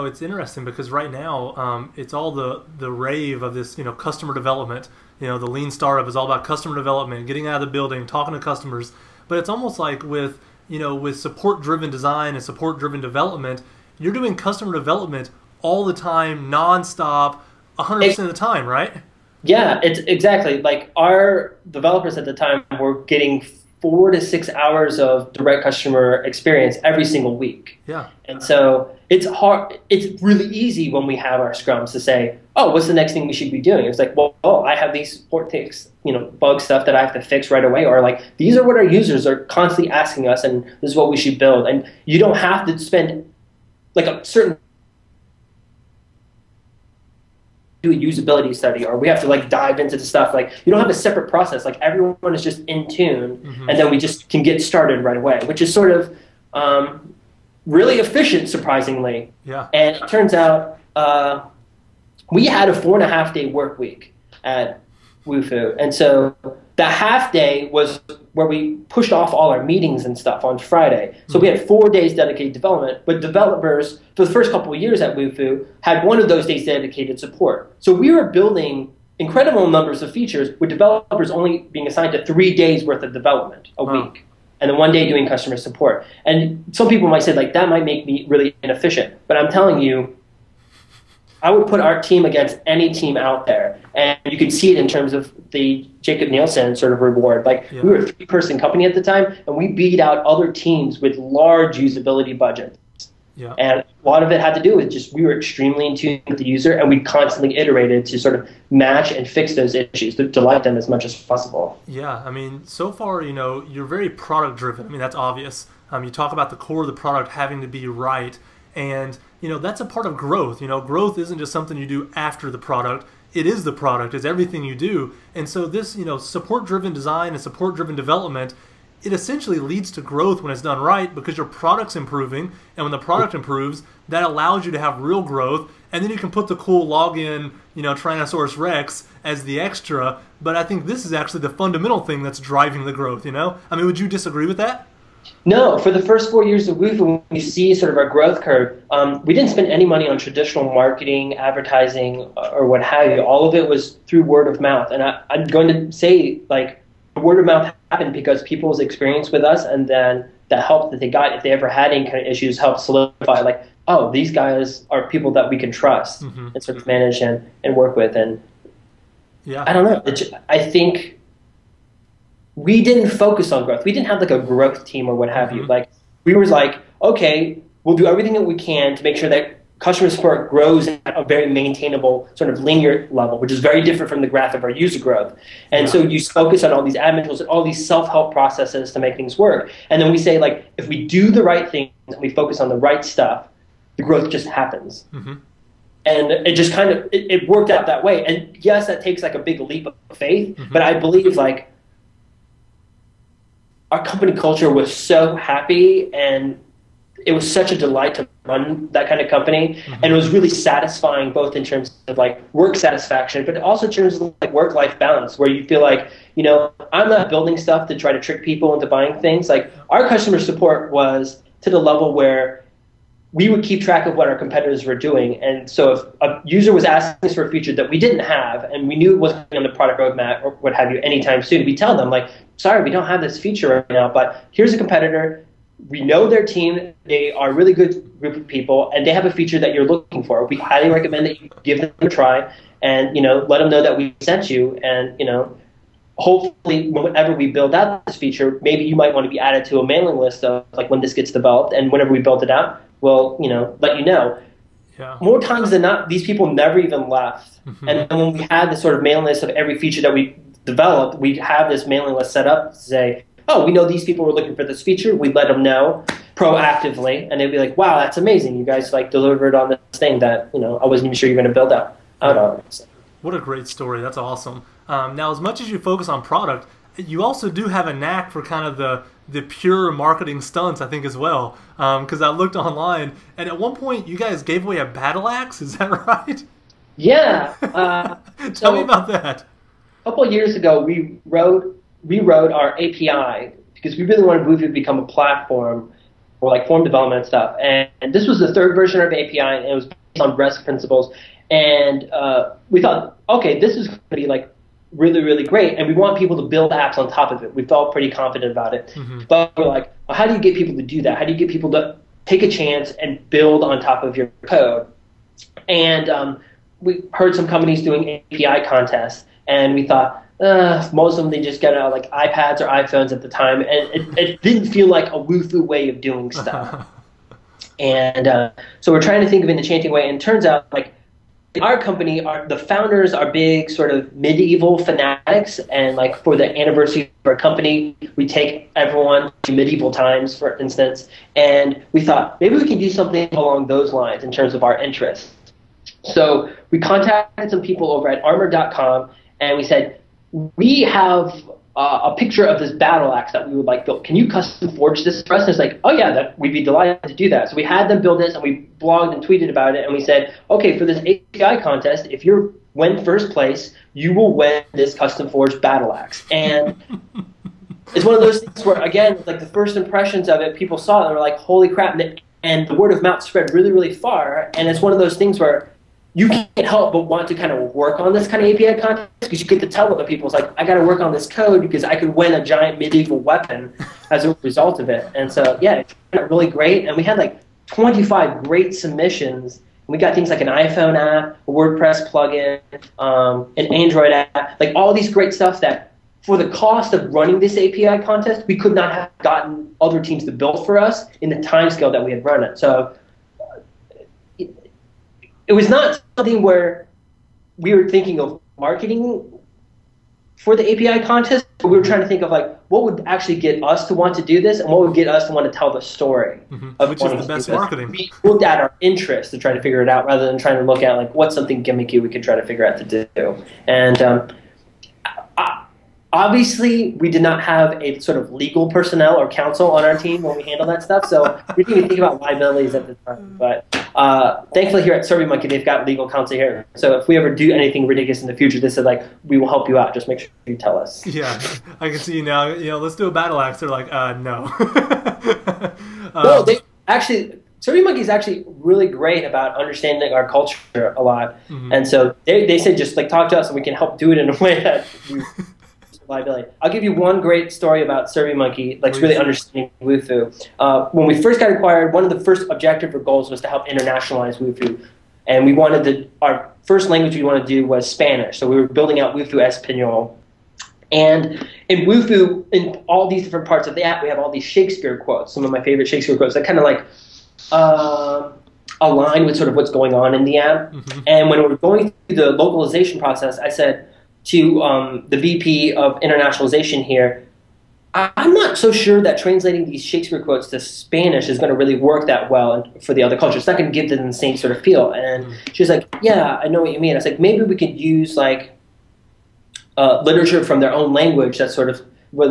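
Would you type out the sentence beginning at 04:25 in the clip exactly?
We let them know proactively, and they'd be like, wow, that's amazing.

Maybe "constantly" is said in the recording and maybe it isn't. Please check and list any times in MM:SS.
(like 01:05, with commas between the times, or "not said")
00:39, 01:46.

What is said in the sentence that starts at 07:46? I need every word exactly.
Our first language we wanted to do was Spanish, so we were building out Wufoo Espanol.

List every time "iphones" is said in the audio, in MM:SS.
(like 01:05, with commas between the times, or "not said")
05:22, 06:30.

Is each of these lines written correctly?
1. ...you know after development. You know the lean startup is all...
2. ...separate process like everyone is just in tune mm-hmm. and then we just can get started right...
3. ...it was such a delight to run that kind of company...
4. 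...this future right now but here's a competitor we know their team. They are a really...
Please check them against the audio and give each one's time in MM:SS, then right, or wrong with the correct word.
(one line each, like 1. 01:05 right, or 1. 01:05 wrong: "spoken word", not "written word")
1. 00:03 wrong: "customer", not "after"
2. 00:50 right
3. 03:27 right
4. 03:53 wrong: "feature", not "future".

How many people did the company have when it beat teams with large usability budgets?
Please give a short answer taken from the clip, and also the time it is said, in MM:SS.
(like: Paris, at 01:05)
3, at 01:38.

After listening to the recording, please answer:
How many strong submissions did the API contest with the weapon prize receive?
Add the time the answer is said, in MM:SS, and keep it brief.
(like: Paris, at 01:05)
25, at 06:27.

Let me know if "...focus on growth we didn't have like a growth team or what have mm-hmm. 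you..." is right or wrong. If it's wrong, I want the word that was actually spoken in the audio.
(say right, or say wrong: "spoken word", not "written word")
right.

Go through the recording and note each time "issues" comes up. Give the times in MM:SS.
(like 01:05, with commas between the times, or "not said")
01:49, 02:42.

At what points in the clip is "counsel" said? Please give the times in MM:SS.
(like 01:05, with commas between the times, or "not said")
07:09, 07:16.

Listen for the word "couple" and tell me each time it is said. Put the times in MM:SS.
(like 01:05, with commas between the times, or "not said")
01:14, 04:50.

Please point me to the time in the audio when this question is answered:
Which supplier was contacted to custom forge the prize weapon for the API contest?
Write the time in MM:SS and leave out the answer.
05:48.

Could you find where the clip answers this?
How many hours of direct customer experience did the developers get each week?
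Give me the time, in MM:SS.
00:23.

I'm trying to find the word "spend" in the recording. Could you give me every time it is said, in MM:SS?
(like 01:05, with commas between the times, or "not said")
00:42, 02:29.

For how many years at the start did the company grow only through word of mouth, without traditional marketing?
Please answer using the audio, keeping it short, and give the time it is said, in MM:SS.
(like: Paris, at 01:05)
4, at 02:26.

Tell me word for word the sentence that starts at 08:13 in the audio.
It's not going to give them the same sort of feel.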